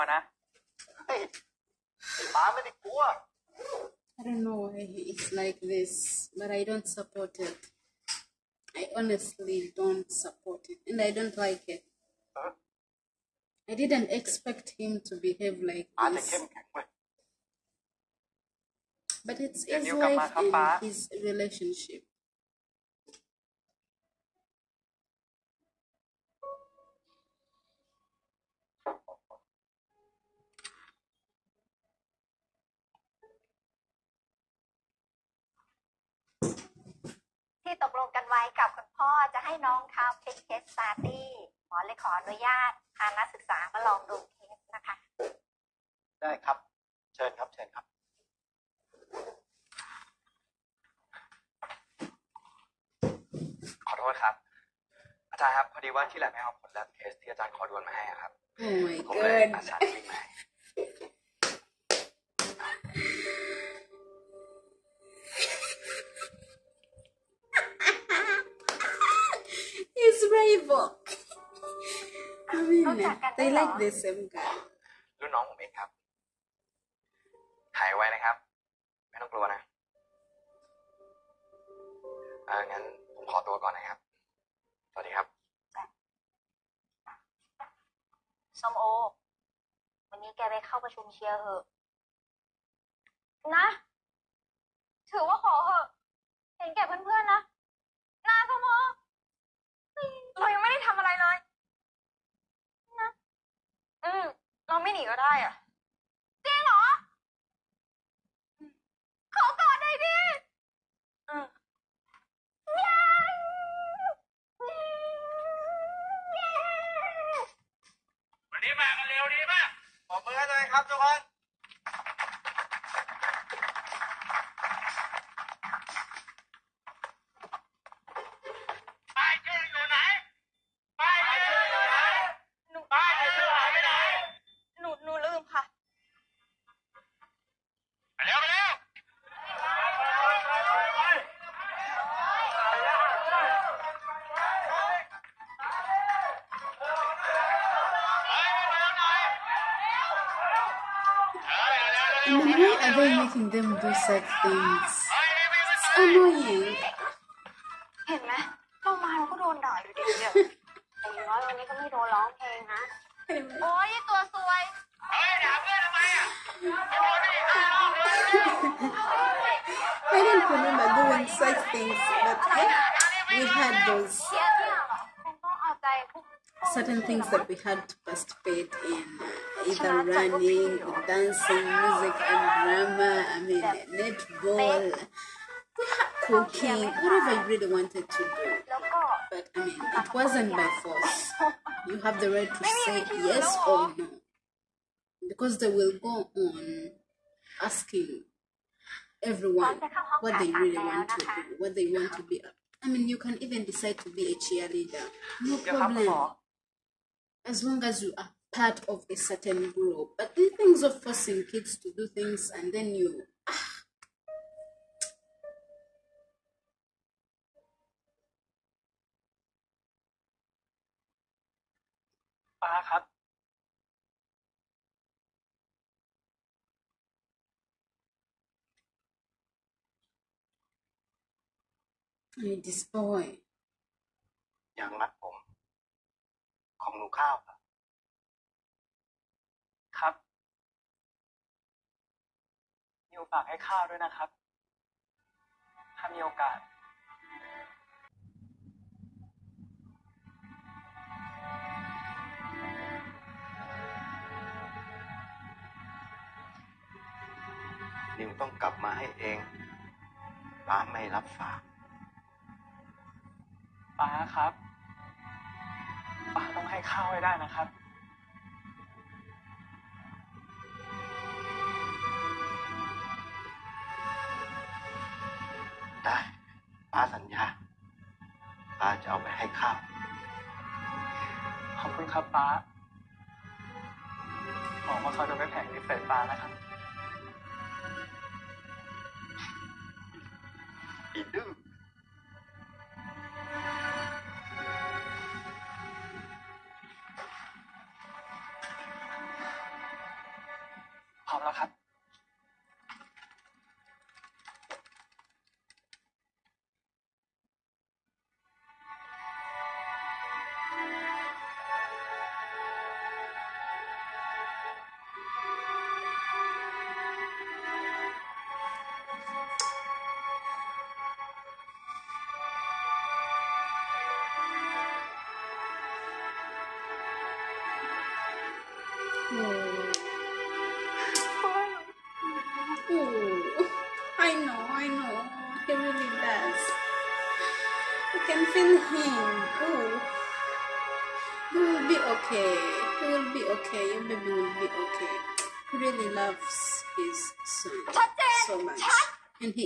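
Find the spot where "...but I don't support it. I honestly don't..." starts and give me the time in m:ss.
0:06.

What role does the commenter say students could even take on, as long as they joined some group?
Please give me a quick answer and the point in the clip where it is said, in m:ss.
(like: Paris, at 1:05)
cheerleader, at 3:24.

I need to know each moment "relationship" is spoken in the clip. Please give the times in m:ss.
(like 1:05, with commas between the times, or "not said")
0:21.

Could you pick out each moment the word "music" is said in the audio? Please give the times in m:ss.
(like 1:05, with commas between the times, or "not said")
3:01.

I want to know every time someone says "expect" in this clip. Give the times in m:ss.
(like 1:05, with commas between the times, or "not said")
0:14.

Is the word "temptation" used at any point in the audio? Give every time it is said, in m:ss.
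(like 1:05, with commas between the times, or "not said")
not said.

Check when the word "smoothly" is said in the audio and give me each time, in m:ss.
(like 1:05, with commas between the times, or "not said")
not said.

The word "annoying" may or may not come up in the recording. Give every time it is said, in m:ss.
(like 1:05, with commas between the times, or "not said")
2:35.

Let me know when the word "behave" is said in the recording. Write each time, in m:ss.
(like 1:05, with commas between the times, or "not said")
0:15.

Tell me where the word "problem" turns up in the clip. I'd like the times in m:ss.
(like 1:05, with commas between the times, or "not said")
3:25.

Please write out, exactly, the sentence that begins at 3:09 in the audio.
But I mean, it wasn't by force.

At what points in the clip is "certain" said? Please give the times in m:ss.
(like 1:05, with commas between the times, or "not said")
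2:56, 3:29.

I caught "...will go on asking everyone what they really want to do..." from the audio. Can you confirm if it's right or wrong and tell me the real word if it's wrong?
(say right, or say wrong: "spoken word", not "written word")
right.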